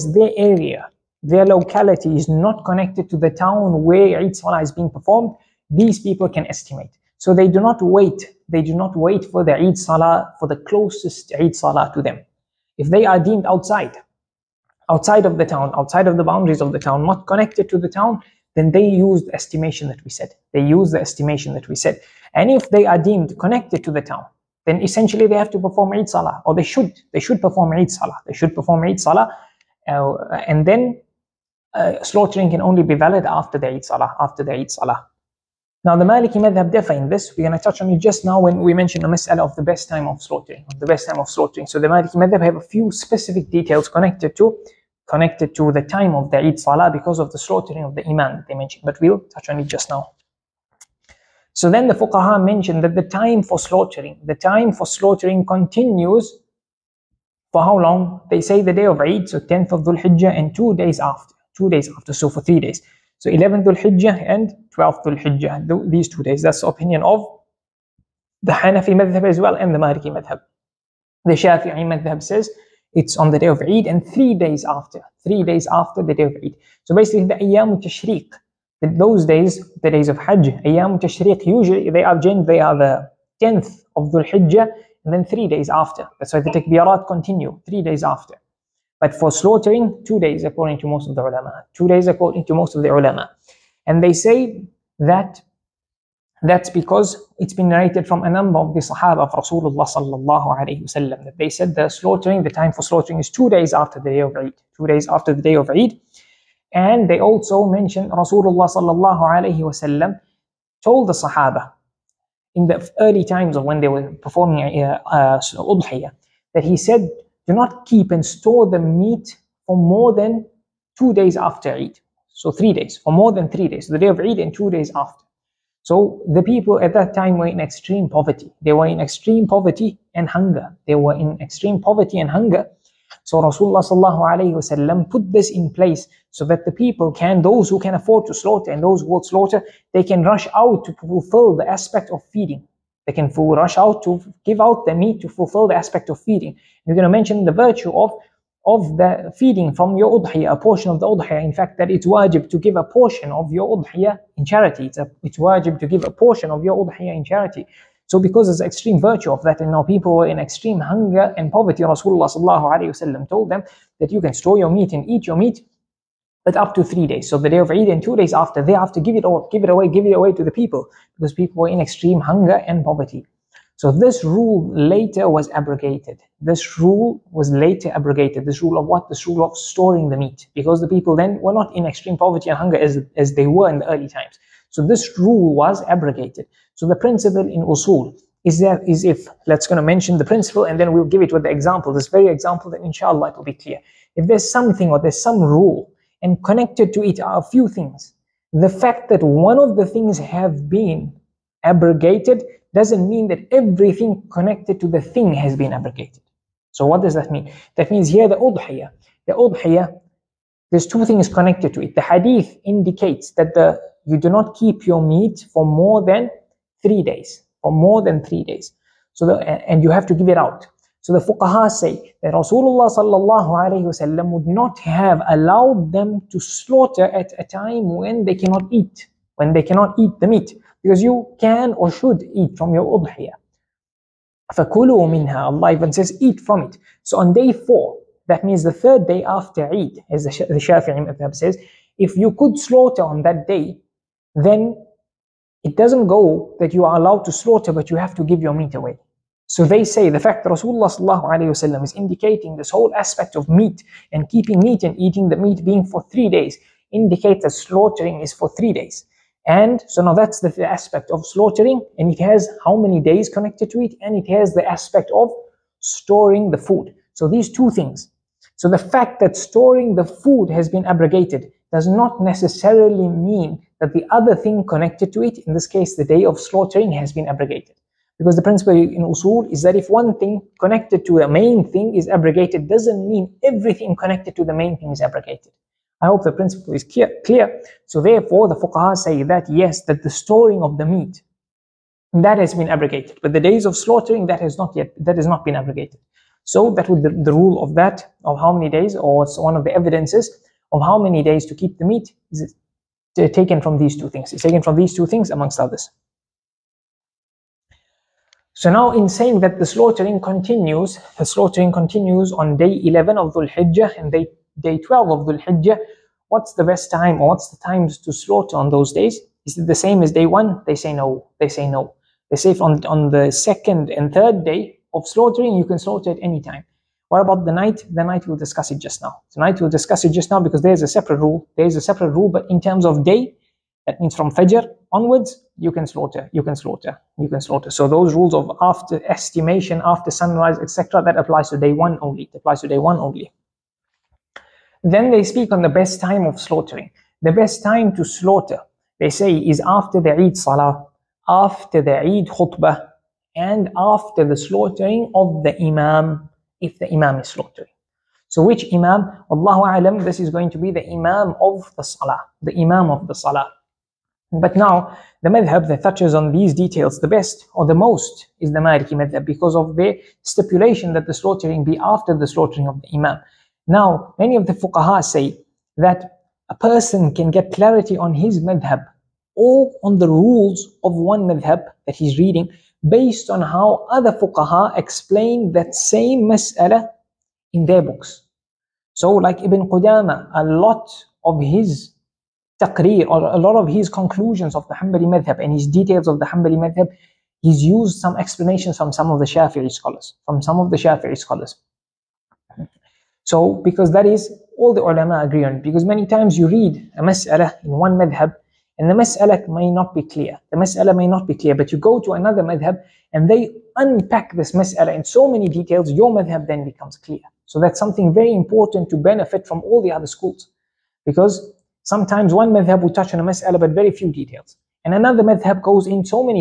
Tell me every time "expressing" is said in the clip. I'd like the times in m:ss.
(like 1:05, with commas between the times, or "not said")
not said.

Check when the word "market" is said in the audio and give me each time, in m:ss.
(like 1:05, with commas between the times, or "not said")
not said.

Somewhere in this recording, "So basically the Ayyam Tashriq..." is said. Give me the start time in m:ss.
1:16.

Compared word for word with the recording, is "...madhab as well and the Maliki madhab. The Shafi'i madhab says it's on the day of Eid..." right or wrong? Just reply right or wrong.
right.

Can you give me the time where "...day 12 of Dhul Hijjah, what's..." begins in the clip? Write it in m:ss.
5:14.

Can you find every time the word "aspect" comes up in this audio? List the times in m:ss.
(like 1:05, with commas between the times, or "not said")
2:21, 2:25, 4:12, 4:20, 4:24.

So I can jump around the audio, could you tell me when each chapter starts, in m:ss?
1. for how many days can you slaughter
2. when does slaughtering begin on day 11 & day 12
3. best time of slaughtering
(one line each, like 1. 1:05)
1. 0:50
2. 5:07
3. 5:45.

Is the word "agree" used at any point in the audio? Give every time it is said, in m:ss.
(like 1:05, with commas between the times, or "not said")
6:45.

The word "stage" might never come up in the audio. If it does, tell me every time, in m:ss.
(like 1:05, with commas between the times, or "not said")
not said.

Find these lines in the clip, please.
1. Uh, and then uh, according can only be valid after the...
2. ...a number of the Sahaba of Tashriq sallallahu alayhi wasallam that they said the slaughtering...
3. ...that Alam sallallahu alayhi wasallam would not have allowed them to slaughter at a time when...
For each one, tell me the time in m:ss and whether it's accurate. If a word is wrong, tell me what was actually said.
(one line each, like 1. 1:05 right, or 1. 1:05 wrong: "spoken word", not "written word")
1. 0:29 wrong: "slaughtering", not "according"
2. 1:38 wrong: "Rasulullah", not "Tashriq"
3. 3:42 wrong: "Rasulullah", not "Alam".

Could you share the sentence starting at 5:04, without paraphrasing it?
It's taken from these two things amongst others.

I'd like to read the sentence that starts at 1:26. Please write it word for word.
That's why the takbirat continue three days after.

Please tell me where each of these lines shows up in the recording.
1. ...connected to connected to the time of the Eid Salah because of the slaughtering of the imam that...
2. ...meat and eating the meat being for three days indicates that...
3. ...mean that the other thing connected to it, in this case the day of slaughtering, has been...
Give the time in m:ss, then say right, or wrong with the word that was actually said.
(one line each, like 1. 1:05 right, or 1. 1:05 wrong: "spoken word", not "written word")
1. 0:43 right
2. 4:14 right
3. 4:33 right.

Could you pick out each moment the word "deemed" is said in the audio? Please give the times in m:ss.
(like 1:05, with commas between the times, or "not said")
0:13, 0:22.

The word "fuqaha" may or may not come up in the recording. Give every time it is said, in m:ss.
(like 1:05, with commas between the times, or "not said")
0:51, 3:41, 4:48, 6:14, 6:24.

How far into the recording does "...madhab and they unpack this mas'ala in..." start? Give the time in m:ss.
6:52.